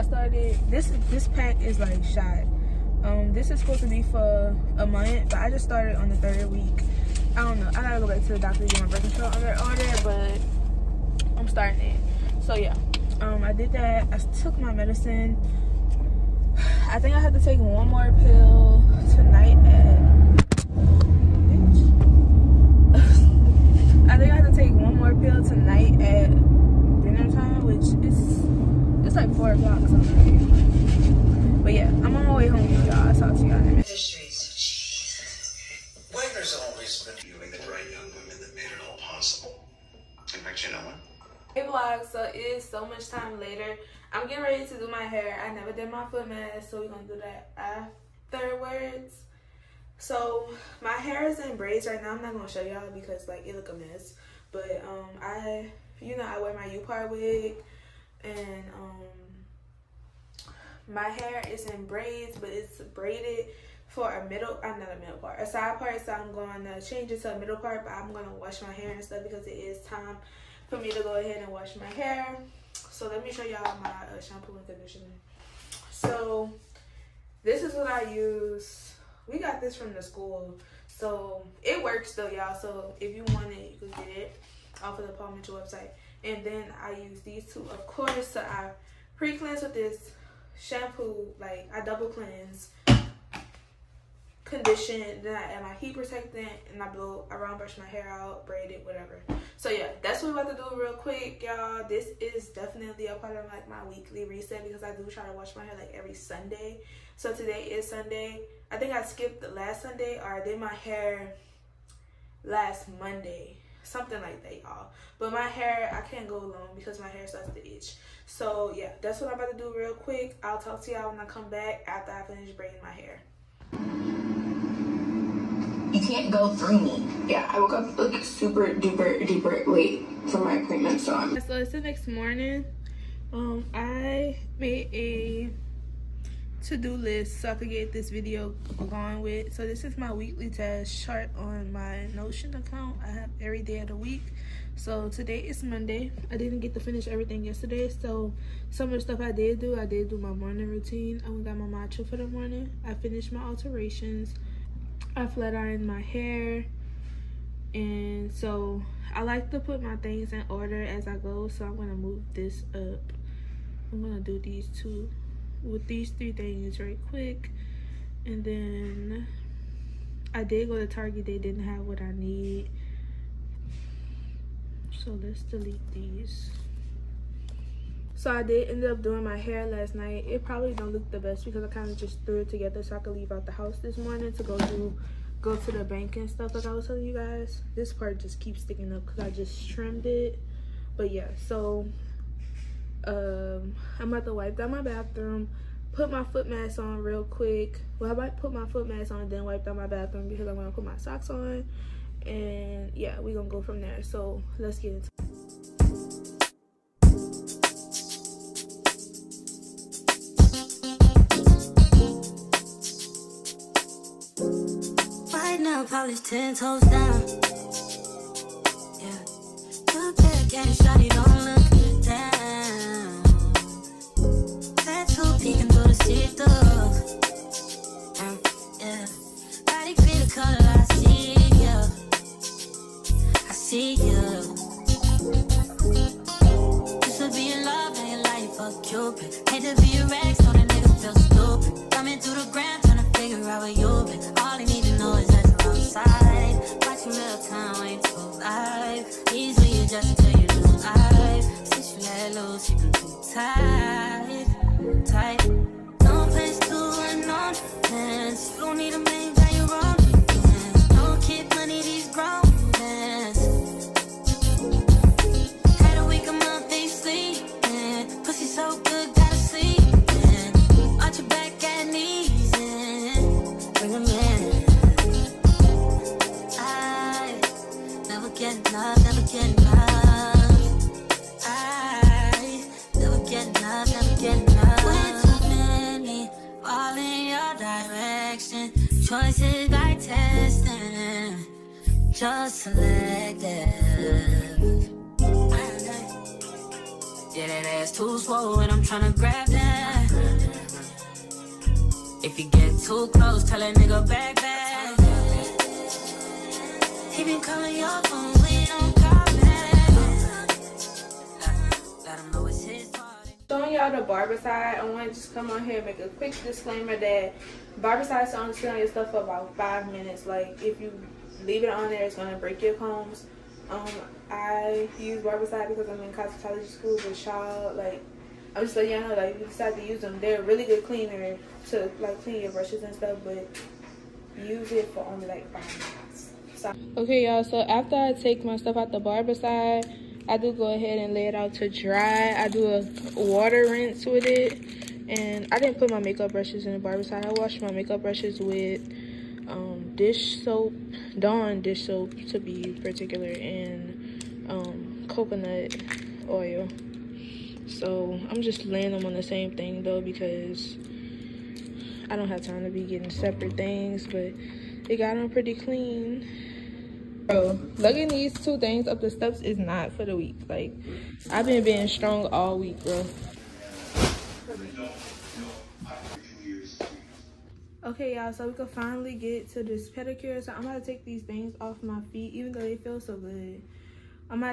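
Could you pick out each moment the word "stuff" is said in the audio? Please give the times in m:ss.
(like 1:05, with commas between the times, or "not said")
1:09, 2:29, 3:06, 5:18, 5:32, 5:38.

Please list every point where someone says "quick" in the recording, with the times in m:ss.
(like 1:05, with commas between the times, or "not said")
1:40, 1:59, 2:47, 3:17, 5:16.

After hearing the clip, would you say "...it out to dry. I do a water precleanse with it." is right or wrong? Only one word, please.
wrong.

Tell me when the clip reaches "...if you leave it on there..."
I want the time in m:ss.
5:20.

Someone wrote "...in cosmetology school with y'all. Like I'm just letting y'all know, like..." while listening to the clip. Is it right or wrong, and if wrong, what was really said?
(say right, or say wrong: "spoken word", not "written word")
right.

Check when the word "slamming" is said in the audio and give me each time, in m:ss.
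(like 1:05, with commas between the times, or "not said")
not said.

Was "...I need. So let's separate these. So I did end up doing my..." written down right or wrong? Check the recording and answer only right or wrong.
wrong.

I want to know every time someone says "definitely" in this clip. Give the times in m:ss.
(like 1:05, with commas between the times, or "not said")
1:42.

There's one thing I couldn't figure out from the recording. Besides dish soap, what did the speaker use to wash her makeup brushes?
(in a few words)
coconut oil.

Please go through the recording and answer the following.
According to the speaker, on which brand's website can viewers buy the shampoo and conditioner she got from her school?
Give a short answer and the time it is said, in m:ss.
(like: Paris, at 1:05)
Paul Mitchell, at 1:25.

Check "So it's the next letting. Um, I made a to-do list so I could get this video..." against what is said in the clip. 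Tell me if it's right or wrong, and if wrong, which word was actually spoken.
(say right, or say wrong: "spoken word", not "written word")
wrong: "morning", not "letting".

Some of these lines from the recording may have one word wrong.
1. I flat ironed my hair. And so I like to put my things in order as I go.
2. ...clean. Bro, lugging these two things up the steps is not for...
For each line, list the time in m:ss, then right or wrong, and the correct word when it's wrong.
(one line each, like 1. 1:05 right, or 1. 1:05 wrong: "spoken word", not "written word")
1. 2:35 right
2. 6:05 right.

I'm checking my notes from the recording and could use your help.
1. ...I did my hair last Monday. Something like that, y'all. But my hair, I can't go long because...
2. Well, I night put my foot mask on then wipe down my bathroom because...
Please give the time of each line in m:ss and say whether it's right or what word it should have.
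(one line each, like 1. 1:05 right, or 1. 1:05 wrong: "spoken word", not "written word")
1. 1:50 right
2. 3:17 wrong: "might", not "night".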